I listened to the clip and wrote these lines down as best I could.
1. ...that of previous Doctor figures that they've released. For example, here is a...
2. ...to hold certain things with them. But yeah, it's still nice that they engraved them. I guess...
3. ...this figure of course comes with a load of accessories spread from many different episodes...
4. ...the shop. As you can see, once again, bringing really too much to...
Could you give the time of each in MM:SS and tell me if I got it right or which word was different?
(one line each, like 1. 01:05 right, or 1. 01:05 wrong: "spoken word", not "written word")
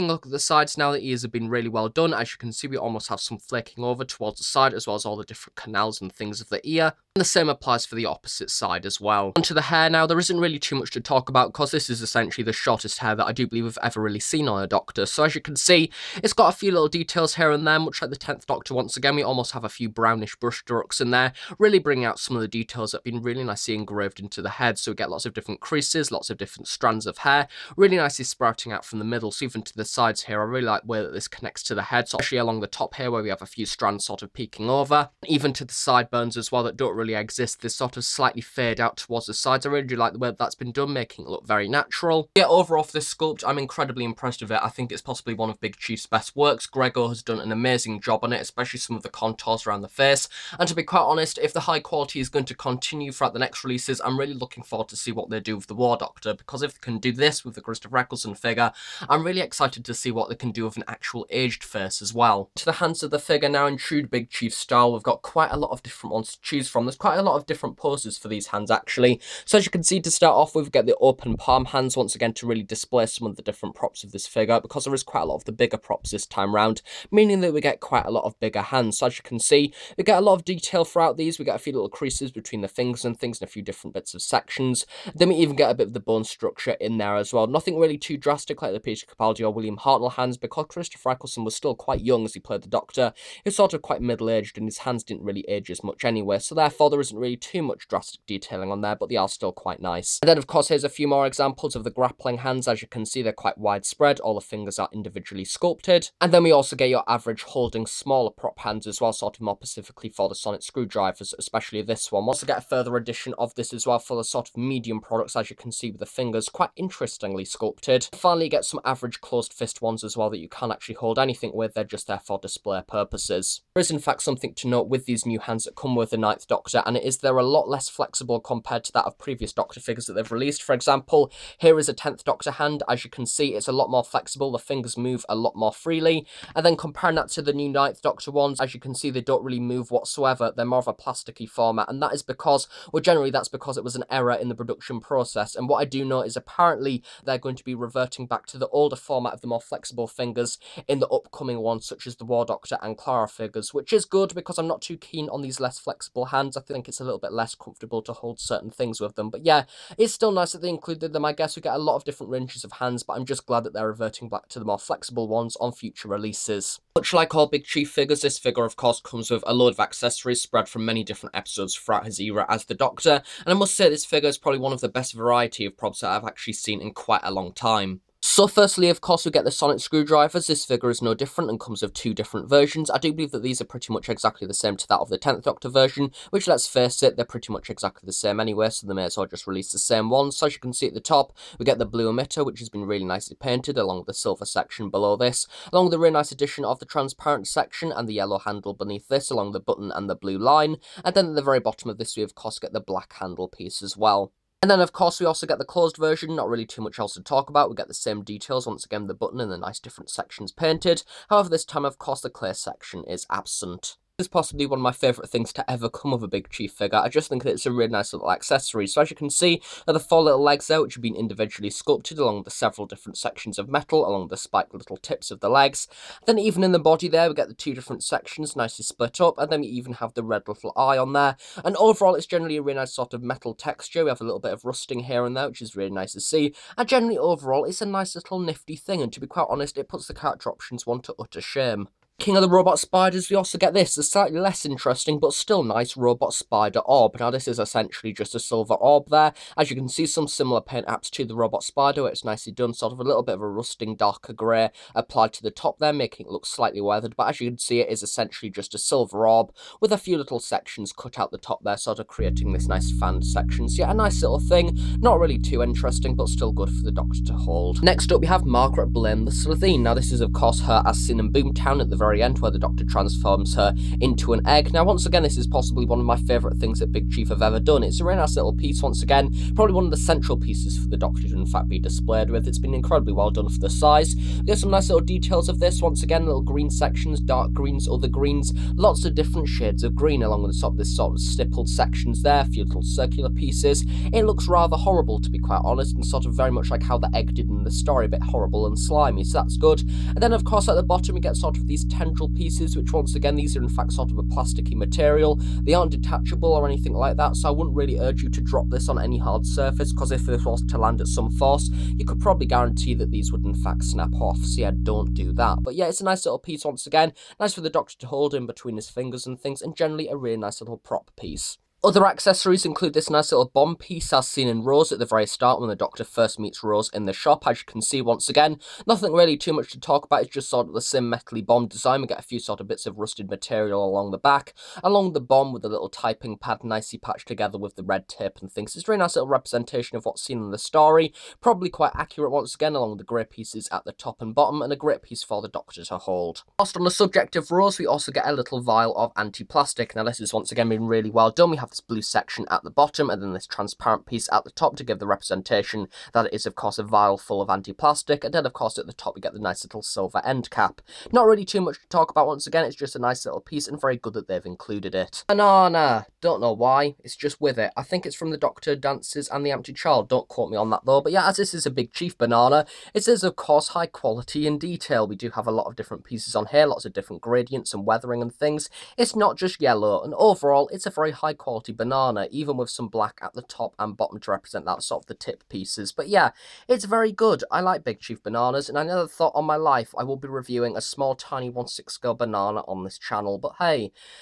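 1. 02:08 right
2. 02:38 wrong: "included", not "engraved"
3. 02:48 right
4. 05:27 wrong: "nothing", not "bringing".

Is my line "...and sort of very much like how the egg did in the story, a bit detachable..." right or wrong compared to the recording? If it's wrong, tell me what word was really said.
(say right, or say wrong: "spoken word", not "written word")
wrong: "horrible", not "detachable".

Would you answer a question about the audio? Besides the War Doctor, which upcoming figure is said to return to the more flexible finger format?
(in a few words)
Clara.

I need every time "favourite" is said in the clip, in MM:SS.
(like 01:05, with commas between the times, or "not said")
03:34, 04:36.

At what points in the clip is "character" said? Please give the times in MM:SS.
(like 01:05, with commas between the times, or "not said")
04:00.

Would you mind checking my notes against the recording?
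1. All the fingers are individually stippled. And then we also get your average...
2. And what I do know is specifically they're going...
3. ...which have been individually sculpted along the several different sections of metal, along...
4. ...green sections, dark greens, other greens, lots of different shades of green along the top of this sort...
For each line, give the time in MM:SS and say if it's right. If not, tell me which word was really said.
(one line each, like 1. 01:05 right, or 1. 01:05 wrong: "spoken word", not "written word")
1. 01:44 wrong: "sculpted", not "stippled"
2. 02:25 wrong: "apparently", not "specifically"
3. 03:40 right
4. 04:46 right.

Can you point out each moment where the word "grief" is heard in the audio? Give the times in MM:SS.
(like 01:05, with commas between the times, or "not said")
not said.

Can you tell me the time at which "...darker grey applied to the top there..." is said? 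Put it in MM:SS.
04:13.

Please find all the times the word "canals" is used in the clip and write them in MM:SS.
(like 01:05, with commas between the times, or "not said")
00:05.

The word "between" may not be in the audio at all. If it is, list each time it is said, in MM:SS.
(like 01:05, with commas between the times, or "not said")
01:22, 05:18.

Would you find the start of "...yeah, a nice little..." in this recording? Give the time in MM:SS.
04:23.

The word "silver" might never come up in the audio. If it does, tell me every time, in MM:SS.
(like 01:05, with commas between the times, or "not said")
03:14, 04:08, 04:18, 05:59.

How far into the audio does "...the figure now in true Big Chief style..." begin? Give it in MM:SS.
01:03.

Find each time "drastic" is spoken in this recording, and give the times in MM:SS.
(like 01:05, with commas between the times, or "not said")
01:28, 01:37.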